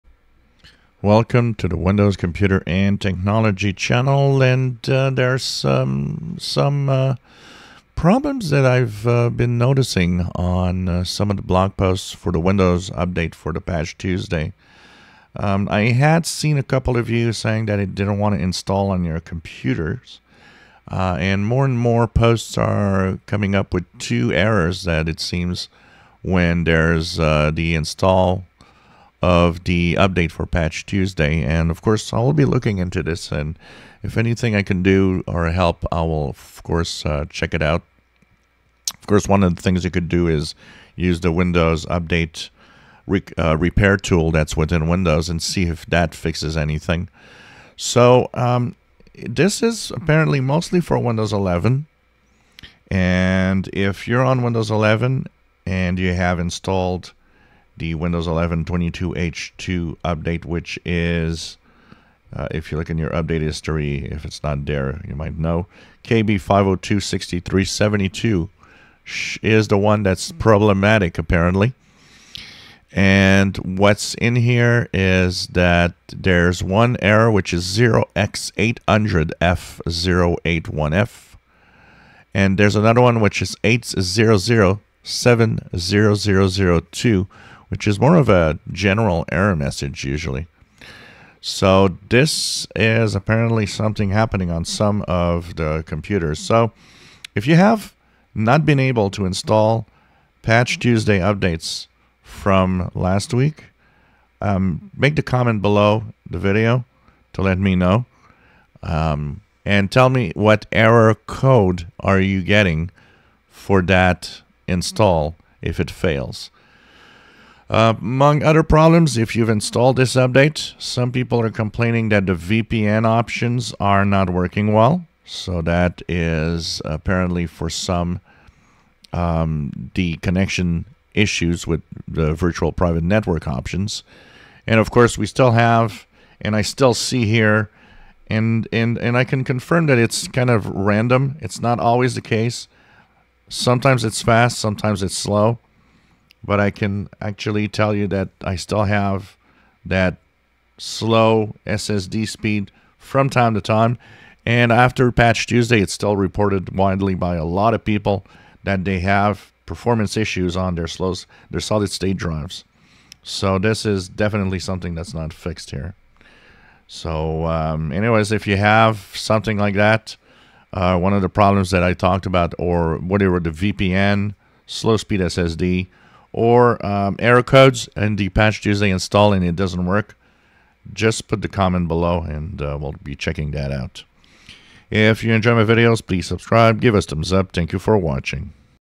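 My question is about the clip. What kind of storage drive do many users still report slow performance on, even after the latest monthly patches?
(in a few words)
solid state drives.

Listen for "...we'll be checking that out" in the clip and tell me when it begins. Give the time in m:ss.
3:02.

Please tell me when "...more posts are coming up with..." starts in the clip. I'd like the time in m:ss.
0:21.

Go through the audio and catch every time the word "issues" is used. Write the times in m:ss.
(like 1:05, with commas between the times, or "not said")
2:11, 2:40.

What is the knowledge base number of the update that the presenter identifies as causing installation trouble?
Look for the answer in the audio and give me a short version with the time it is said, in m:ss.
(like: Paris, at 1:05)
KB5026372, at 1:06.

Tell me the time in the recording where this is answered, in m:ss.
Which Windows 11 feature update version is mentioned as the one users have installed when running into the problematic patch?
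0:58.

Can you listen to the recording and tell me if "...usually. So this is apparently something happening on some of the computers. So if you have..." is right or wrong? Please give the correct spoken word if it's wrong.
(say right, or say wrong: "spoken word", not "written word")
right.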